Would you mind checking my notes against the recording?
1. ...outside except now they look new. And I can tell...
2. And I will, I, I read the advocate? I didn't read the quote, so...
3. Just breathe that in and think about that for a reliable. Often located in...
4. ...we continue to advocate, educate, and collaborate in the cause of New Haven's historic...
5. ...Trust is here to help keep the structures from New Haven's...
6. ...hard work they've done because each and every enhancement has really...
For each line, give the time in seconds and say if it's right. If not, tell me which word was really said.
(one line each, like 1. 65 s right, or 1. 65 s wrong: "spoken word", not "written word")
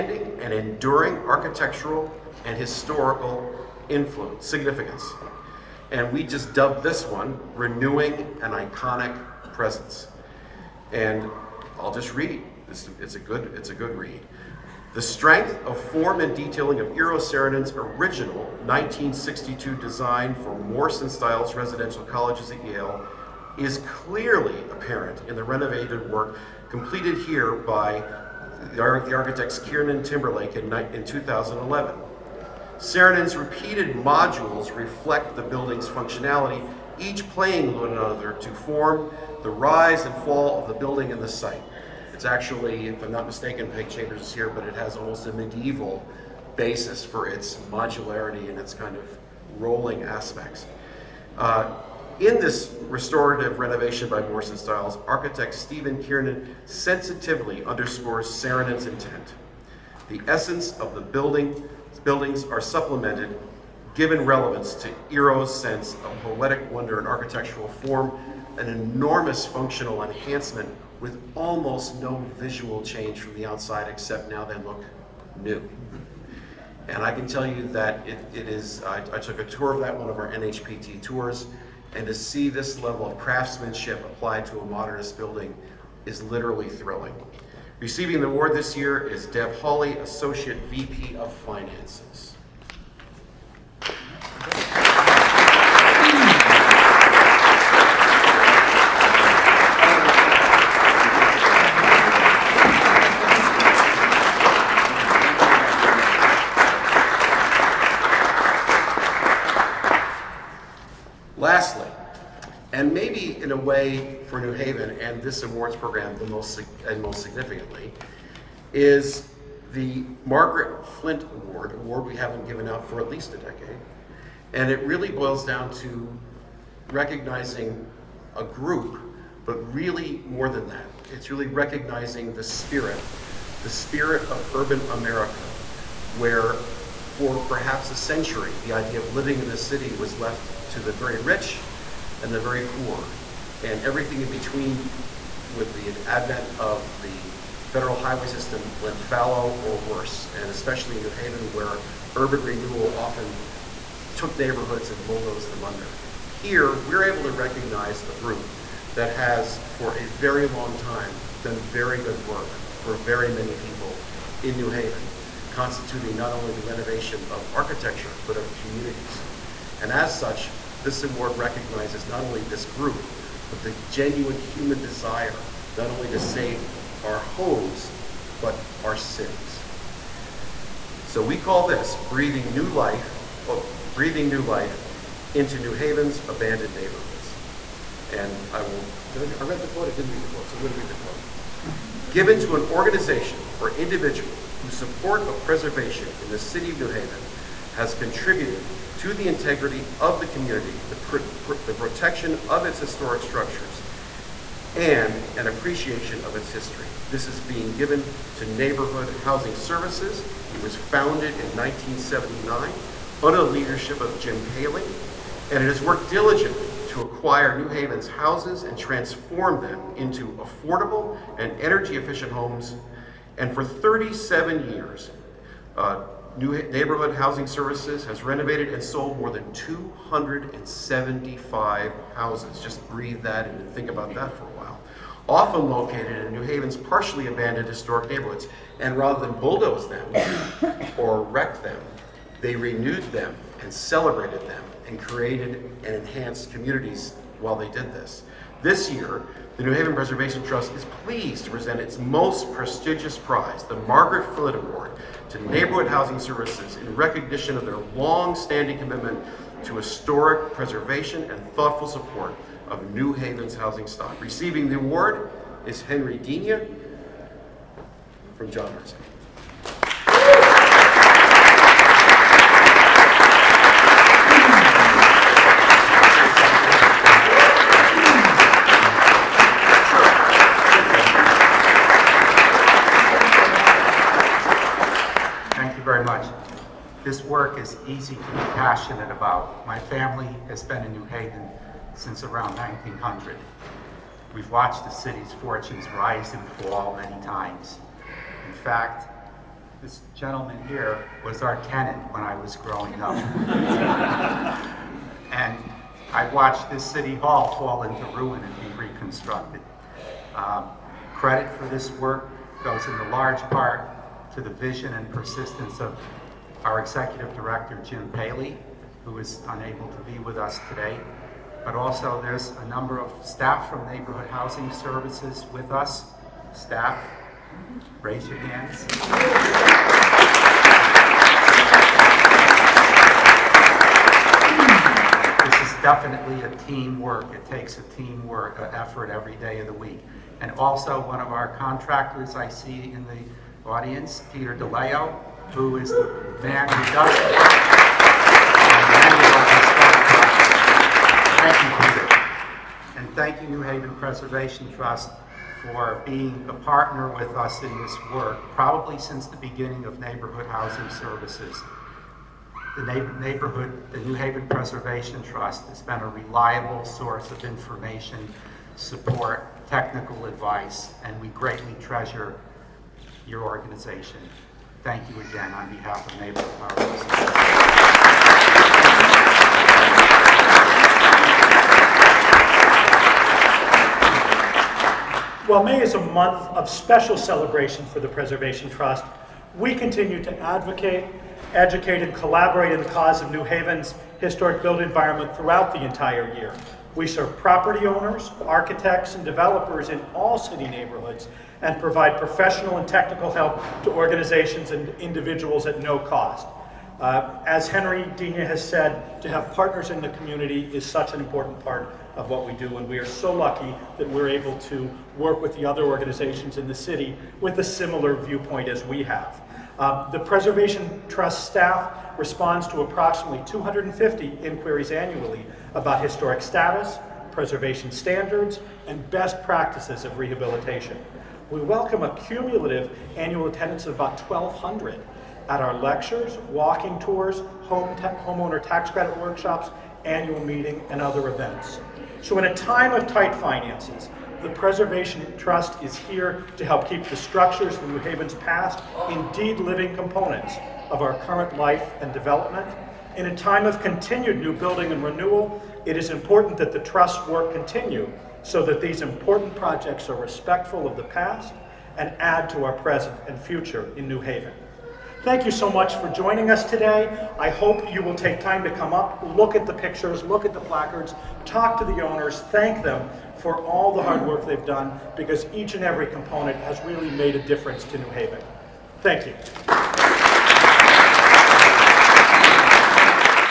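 1. 73 s right
2. 188 s wrong: "quote", not "advocate"
3. 232 s wrong: "while", not "reliable"
4. 389 s right
5. 445 s right
6. 474 s wrong: "component", not "enhancement".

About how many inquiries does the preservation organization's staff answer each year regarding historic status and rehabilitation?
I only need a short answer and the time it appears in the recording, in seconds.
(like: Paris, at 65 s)
250, at 423 s.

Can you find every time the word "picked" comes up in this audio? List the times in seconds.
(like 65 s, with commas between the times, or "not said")
not said.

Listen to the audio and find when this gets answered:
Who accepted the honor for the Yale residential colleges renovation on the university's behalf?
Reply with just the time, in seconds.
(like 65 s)
89 s.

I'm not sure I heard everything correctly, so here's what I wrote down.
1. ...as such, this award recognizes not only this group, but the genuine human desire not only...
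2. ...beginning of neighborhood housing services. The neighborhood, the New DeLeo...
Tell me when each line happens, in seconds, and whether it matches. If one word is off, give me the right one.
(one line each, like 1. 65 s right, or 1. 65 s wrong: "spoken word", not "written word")
1. 169 s right
2. 359 s wrong: "Haven", not "DeLeo".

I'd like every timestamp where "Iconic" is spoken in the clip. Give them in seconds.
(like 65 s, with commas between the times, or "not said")
8 s.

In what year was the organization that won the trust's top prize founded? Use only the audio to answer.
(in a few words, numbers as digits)
1979.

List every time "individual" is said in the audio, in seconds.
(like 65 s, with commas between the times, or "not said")
193 s, 404 s.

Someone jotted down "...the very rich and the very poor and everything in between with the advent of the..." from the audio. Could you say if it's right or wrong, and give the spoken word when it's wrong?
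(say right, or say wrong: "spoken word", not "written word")
right.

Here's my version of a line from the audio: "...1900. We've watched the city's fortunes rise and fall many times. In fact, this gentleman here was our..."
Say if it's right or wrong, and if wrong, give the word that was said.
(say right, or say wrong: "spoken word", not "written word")
right.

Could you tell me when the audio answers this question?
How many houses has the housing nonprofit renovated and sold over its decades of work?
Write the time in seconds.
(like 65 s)
229 s.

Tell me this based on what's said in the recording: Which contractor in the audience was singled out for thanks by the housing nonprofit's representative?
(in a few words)
Peter DeLeo.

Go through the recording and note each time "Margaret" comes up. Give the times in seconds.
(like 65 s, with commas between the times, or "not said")
120 s, 253 s.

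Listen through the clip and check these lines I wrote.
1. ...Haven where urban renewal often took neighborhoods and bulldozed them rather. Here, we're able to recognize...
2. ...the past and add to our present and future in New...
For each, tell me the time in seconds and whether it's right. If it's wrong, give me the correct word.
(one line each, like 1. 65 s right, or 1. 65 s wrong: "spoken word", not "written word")
1. 151 s wrong: "under", not "rather"
2. 460 s right.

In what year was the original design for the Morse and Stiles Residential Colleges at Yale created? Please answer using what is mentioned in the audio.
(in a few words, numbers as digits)
1962.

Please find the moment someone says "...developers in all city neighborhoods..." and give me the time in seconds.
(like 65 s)
399 s.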